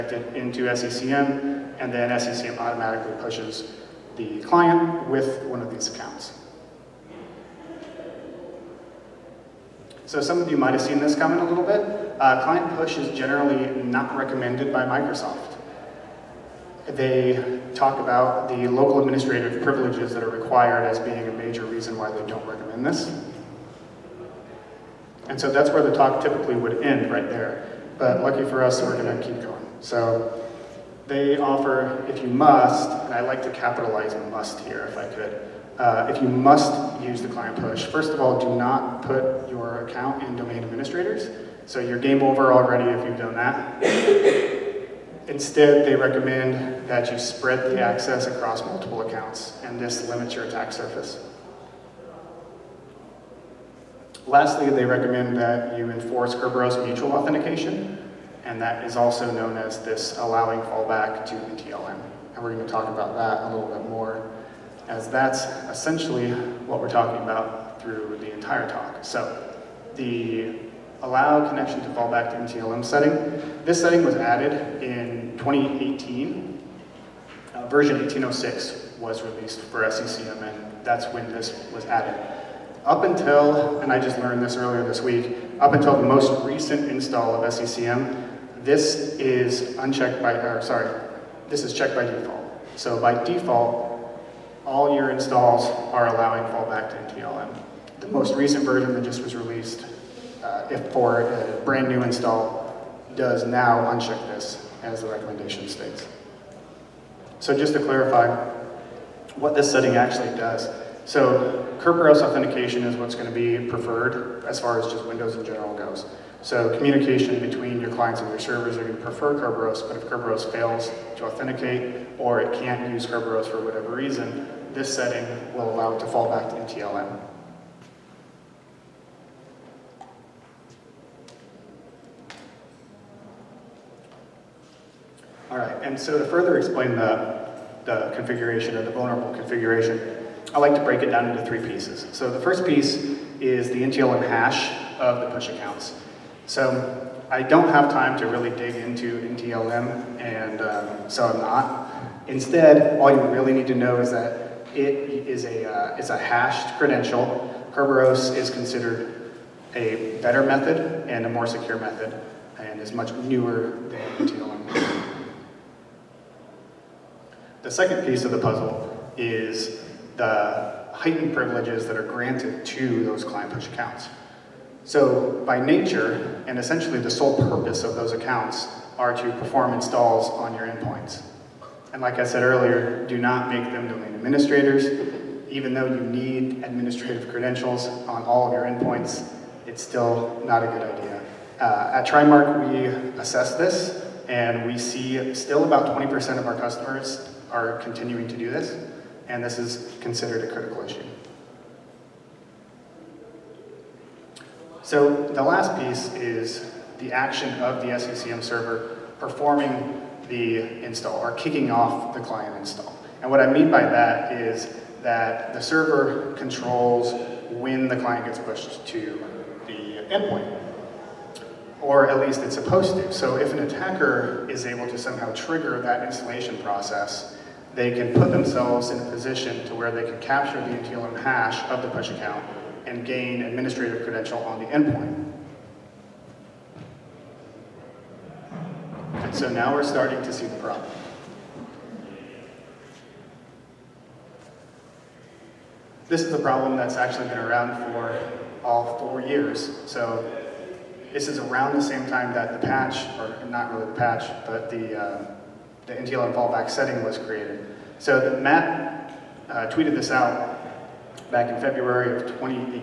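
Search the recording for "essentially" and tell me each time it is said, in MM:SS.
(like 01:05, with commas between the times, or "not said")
01:05, 02:56.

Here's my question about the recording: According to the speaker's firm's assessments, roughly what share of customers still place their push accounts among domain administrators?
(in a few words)
20%.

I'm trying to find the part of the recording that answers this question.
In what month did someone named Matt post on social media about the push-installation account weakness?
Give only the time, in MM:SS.
04:21.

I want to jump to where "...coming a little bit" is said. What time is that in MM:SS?
00:11.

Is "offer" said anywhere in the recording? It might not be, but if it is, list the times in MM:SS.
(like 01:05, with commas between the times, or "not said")
00:31.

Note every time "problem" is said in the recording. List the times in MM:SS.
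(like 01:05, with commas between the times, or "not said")
04:00, 04:06.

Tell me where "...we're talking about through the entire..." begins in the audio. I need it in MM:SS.
01:06.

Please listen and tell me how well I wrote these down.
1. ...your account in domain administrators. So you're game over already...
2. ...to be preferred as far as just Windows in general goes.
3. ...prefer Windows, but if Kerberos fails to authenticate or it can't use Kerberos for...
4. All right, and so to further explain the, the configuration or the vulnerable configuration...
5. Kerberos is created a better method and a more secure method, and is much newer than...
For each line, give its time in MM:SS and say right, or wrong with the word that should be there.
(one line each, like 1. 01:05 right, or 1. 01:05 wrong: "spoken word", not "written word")
1. 00:39 right
2. 01:53 right
3. 01:59 wrong: "Kerberos", not "Windows"
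4. 02:15 right
5. 02:37 wrong: "considered", not "created".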